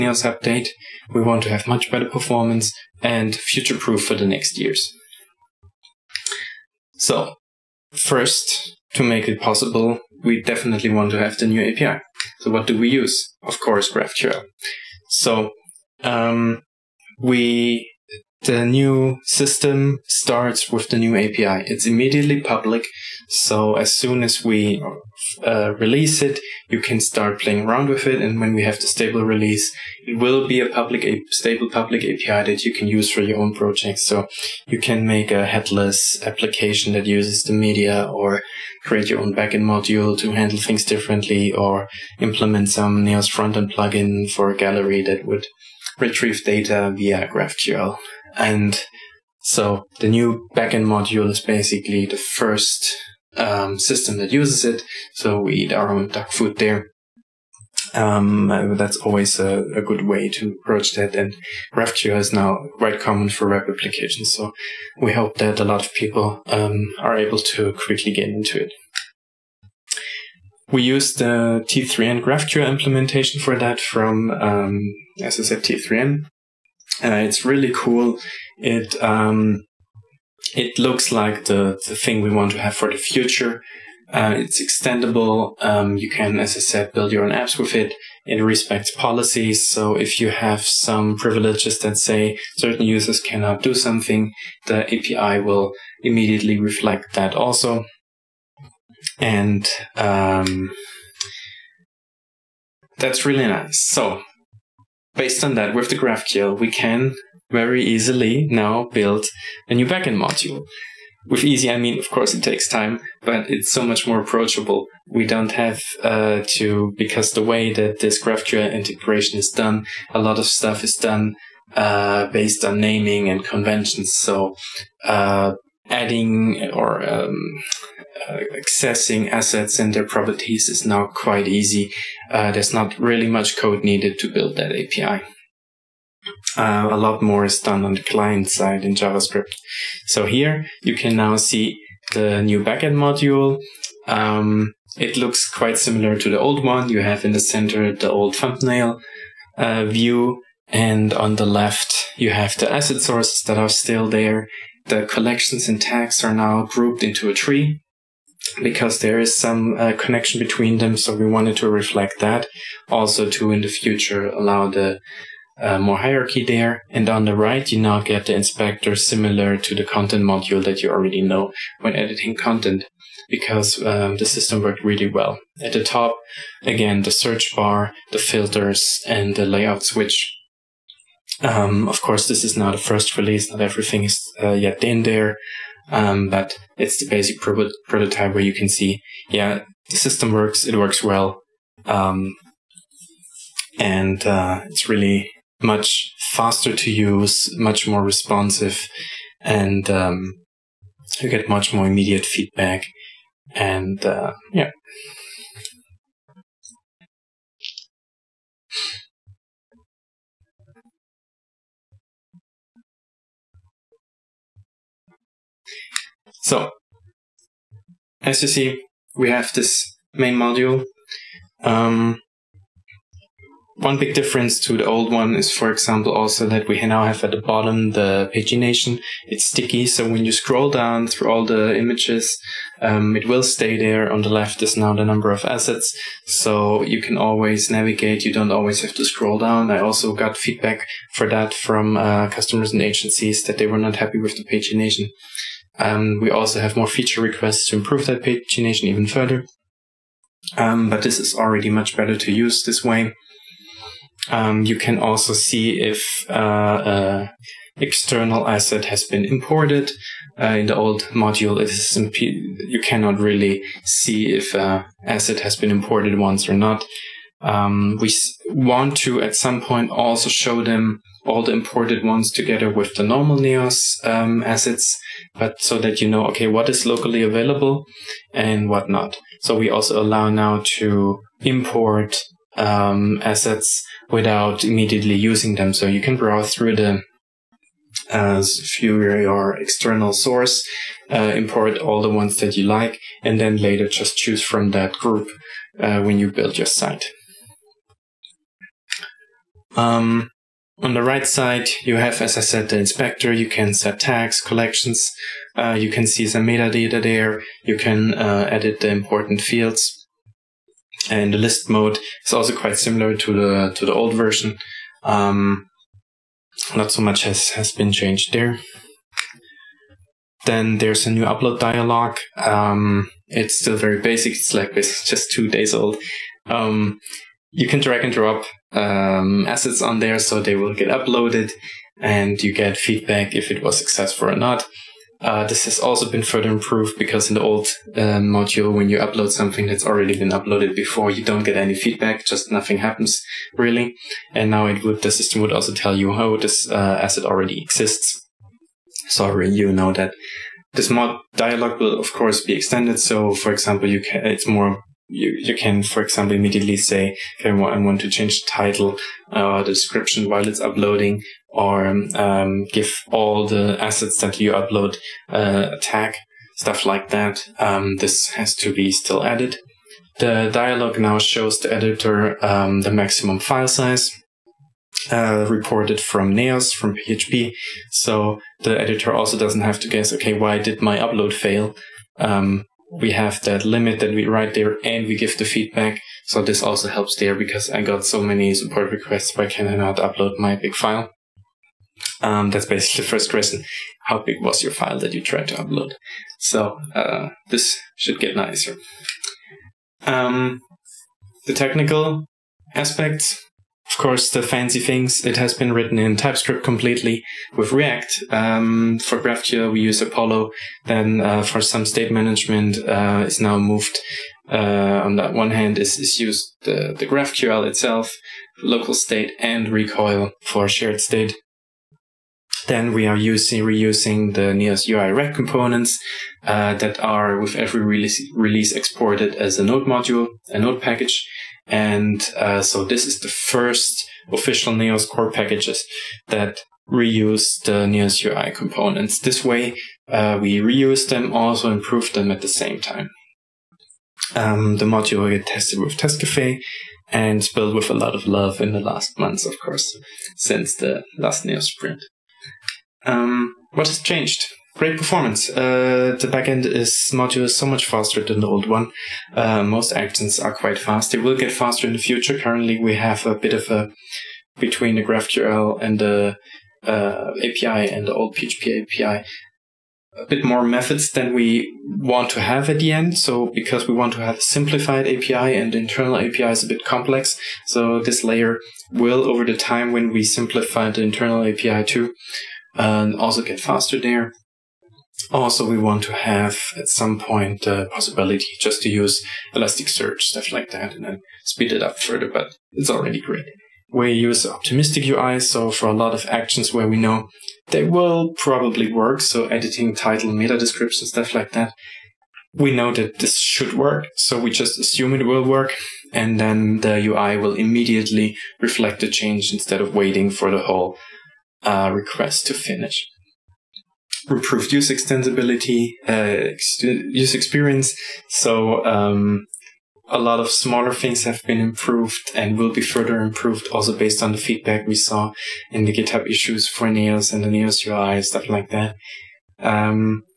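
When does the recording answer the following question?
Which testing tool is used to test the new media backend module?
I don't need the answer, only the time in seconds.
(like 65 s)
445 s.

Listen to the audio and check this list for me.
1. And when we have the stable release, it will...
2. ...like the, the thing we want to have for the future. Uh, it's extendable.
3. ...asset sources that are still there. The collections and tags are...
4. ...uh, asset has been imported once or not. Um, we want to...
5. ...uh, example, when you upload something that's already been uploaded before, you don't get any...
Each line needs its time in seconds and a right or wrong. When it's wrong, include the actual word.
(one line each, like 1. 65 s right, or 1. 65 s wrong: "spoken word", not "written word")
1. 28 s right
2. 81 s right
3. 152 s right
4. 264 s right
5. 337 s wrong: "module", not "example".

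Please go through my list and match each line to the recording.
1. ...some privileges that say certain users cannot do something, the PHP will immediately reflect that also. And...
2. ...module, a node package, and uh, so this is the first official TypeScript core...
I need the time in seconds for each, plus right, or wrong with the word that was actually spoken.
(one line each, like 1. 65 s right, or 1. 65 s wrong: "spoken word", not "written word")
1. 90 s wrong: "API", not "PHP"
2. 429 s wrong: "Neos", not "TypeScript".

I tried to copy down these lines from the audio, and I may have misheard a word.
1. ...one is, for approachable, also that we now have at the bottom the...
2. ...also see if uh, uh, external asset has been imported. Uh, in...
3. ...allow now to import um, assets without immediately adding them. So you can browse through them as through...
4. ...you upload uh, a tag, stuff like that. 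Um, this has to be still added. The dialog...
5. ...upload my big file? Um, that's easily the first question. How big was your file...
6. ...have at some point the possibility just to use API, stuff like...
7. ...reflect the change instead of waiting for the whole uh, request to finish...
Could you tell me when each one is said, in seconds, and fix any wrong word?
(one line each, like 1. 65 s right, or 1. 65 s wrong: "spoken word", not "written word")
1. 225 s wrong: "example", not "approachable"
2. 254 s right
3. 280 s wrong: "using", not "adding"
4. 364 s right
5. 389 s wrong: "basically", not "easily"
6. 486 s wrong: "Elasticsearch", not "API"
7. 508 s right.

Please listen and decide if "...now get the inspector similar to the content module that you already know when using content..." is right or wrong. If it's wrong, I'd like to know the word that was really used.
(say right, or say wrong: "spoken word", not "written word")
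wrong: "editing", not "using".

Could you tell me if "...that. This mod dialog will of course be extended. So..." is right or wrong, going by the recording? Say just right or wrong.
right.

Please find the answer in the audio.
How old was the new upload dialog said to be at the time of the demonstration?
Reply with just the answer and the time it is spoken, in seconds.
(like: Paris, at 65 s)
Two days, at 325 s.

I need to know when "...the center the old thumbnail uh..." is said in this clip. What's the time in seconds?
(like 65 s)
147 s.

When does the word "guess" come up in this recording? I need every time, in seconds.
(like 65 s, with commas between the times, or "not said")
379 s.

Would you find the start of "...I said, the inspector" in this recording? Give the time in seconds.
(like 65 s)
302 s.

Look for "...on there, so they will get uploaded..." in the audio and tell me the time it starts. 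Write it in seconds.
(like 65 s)
329 s.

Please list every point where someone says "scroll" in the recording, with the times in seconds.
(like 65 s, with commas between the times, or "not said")
230 s, 239 s.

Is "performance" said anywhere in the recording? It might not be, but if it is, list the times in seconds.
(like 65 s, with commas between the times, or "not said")
2 s, 454 s.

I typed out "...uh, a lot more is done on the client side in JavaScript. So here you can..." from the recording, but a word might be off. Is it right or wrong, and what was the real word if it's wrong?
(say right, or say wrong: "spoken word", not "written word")
right.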